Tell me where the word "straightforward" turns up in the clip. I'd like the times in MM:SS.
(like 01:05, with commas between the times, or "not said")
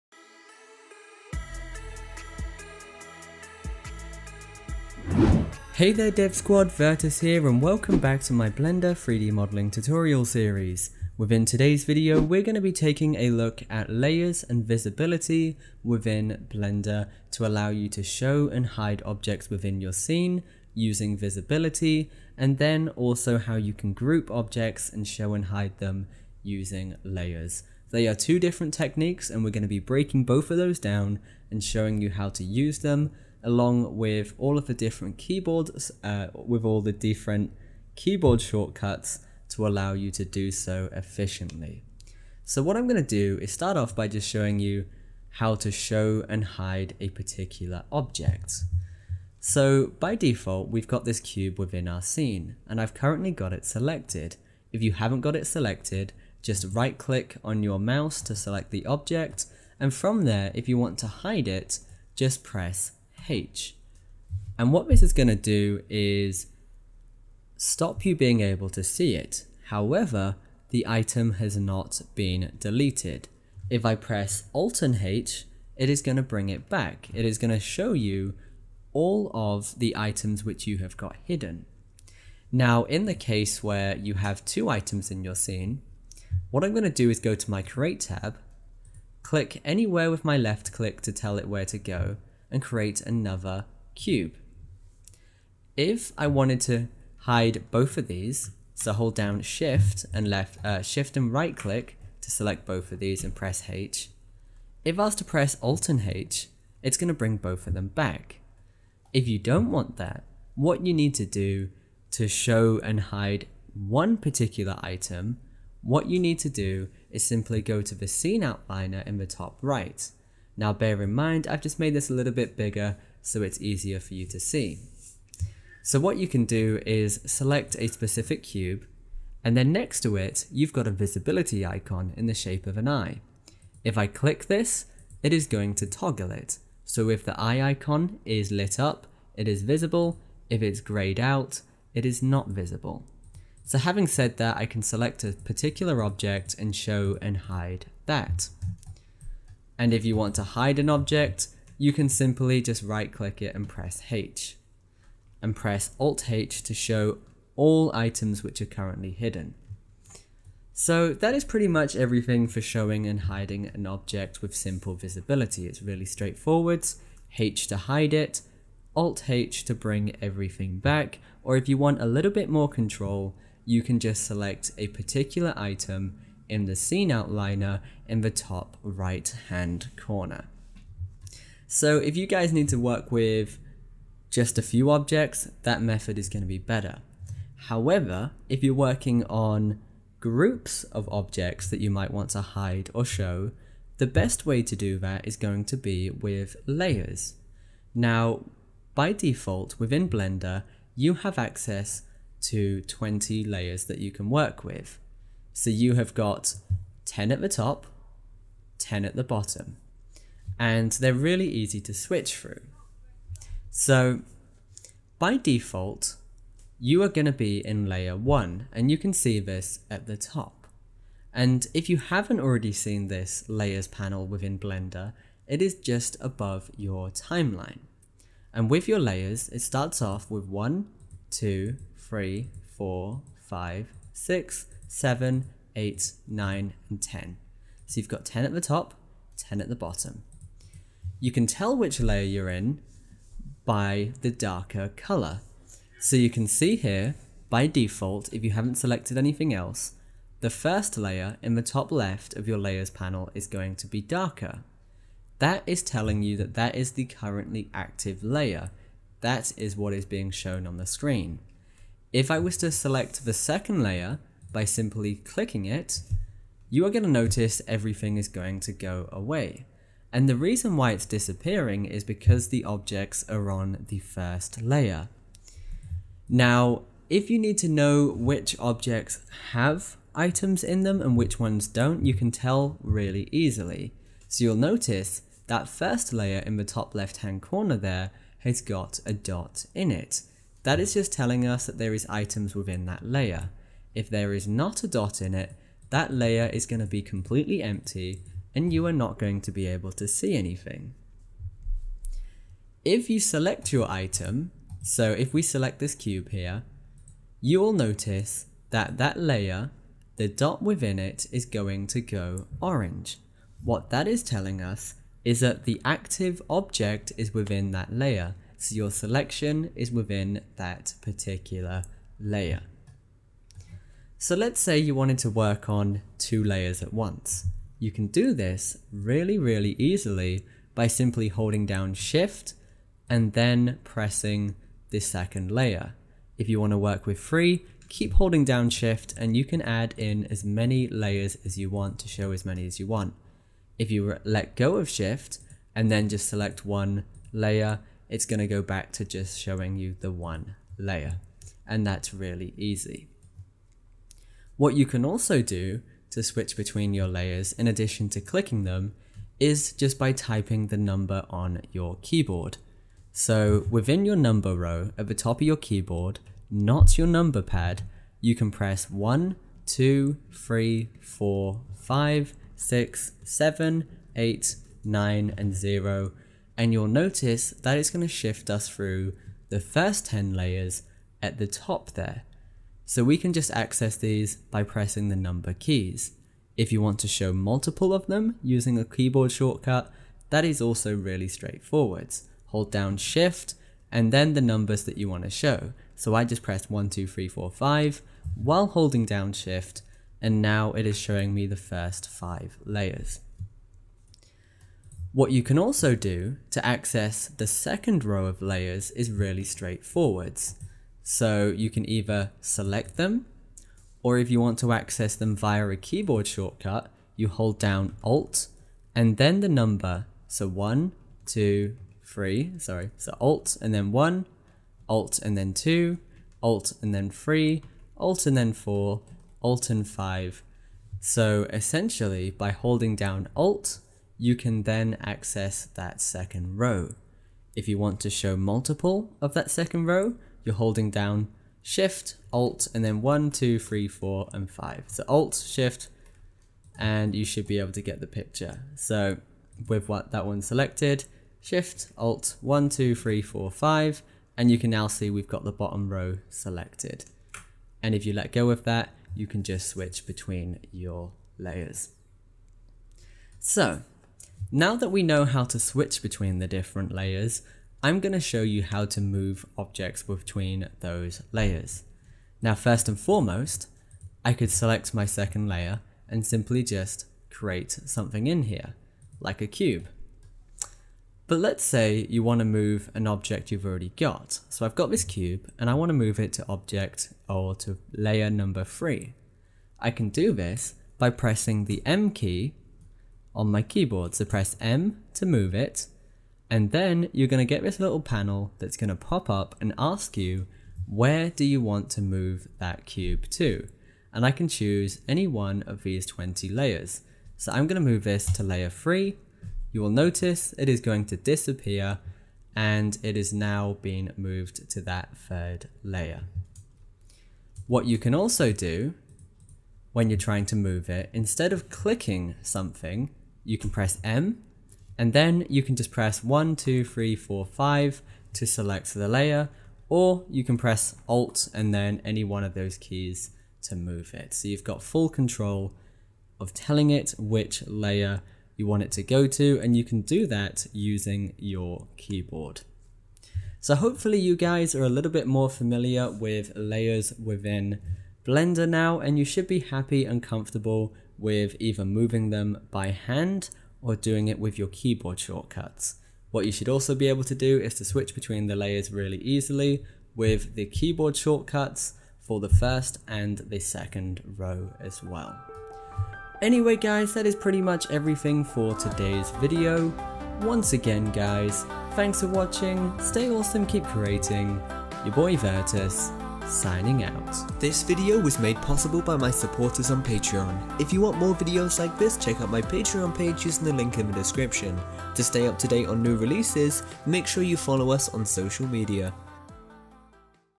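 02:46, 06:31, 06:49.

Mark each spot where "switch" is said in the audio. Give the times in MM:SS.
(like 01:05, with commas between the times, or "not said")
03:31, 05:56, 07:39, 07:45, 09:17.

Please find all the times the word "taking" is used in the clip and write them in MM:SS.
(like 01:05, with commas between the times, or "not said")
00:12.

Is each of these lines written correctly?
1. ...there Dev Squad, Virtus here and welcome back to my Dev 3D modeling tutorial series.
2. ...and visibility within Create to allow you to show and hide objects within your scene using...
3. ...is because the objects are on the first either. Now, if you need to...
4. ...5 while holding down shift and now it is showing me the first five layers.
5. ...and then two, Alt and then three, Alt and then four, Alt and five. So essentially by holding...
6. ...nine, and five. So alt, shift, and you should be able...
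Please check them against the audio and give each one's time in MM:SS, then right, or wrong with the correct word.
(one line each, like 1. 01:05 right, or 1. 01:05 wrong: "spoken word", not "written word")
1. 00:05 wrong: "Blender", not "Dev"
2. 00:14 wrong: "Blender", not "Create"
3. 04:31 wrong: "layer", not "either"
4. 06:37 right
5. 07:05 right
6. 07:23 wrong: "four", not "nine".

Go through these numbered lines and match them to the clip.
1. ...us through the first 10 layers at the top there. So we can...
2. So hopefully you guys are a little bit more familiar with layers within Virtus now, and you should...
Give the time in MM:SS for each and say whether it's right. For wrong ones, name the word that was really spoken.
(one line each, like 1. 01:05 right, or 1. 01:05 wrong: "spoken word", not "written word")
1. 06:18 right
2. 09:03 wrong: "Blender", not "Virtus".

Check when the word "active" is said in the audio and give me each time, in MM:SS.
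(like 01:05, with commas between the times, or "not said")
04:17, 05:15.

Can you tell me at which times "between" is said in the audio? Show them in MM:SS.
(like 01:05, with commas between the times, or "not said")
05:56, 07:40, 07:46, 07:50, 09:18.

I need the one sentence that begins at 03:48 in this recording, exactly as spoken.
And with your layers, it starts off with 1, 2, 3, 4, 5, 6, 7, 8, 9, and 10.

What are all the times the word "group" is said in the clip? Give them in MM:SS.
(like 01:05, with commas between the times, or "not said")
00:23, 03:10.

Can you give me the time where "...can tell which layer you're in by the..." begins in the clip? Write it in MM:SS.
04:01.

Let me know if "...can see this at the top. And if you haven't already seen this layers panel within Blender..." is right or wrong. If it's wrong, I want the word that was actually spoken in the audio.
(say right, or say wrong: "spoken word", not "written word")
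right.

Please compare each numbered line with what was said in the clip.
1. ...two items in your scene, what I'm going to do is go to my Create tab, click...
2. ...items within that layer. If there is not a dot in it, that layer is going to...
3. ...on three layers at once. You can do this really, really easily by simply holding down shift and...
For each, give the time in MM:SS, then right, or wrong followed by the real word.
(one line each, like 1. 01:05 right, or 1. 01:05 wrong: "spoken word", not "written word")
1. 01:24 right
2. 04:52 right
3. 05:25 wrong: "two", not "three".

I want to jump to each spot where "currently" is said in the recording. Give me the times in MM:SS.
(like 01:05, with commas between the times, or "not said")
00:52, 02:38, 04:17.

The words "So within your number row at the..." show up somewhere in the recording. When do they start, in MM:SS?
06:03.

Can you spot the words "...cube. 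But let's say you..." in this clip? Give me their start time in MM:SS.
07:59.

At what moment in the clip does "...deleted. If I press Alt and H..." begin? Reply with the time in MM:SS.
01:12.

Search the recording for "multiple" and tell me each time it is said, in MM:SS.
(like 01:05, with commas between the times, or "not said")
06:27, 07:18.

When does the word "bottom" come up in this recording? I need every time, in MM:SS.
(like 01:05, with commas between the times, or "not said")
03:29, 03:59, 07:35.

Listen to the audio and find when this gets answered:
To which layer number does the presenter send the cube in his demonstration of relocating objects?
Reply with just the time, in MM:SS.
08:27.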